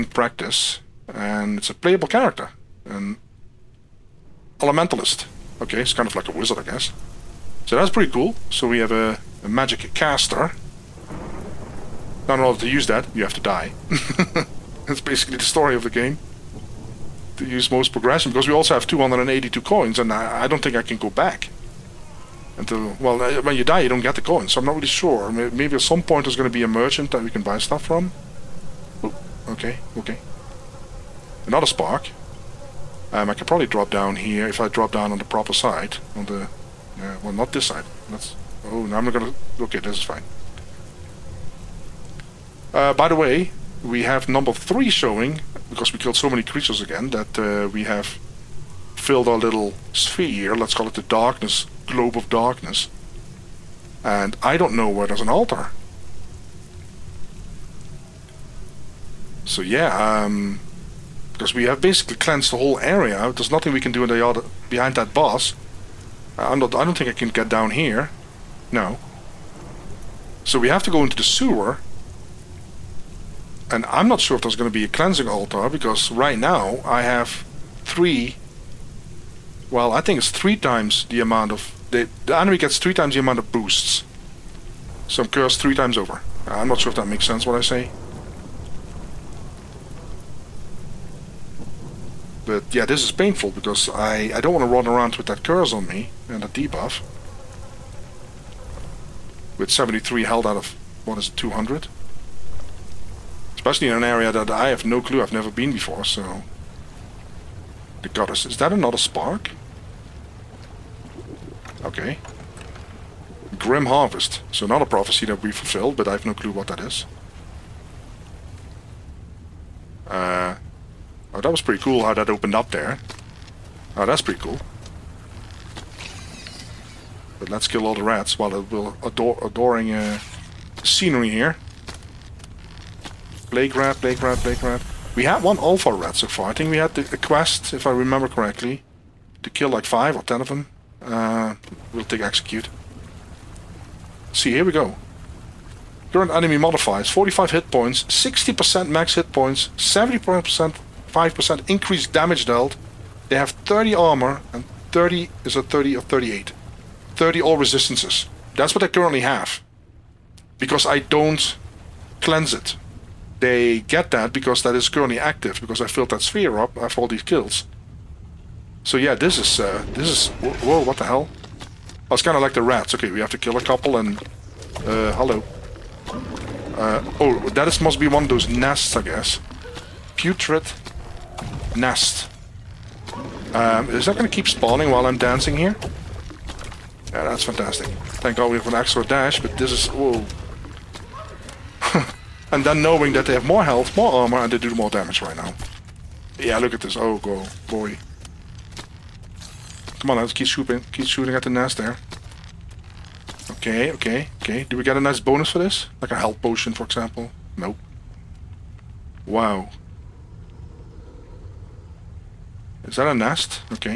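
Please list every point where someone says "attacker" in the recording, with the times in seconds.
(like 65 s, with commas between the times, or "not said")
not said.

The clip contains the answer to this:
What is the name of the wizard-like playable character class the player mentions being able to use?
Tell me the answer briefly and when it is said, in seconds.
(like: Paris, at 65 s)
Elementalist, at 2 s.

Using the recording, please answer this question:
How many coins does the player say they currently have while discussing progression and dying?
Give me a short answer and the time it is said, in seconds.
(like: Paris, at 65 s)
282, at 18 s.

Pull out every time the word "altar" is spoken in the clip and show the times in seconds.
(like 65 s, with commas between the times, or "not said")
55 s, 75 s.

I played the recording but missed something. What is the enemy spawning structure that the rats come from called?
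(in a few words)
Putrid nest.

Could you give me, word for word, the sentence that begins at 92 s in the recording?
But yeah, this is painful because I, I don't want to run around with that curse on me and a debuff.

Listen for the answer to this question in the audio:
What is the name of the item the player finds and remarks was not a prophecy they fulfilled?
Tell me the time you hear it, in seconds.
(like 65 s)
113 s.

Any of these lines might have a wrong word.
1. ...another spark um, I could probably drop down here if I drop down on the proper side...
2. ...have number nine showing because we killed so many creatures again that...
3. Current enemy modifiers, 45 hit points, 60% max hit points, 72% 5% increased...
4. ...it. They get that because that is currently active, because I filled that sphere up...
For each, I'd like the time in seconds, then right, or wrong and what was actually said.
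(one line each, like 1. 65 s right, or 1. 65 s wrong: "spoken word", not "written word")
1. 31 s right
2. 44 s wrong: "three", not "nine"
3. 146 s wrong: "70", not "72"
4. 162 s right.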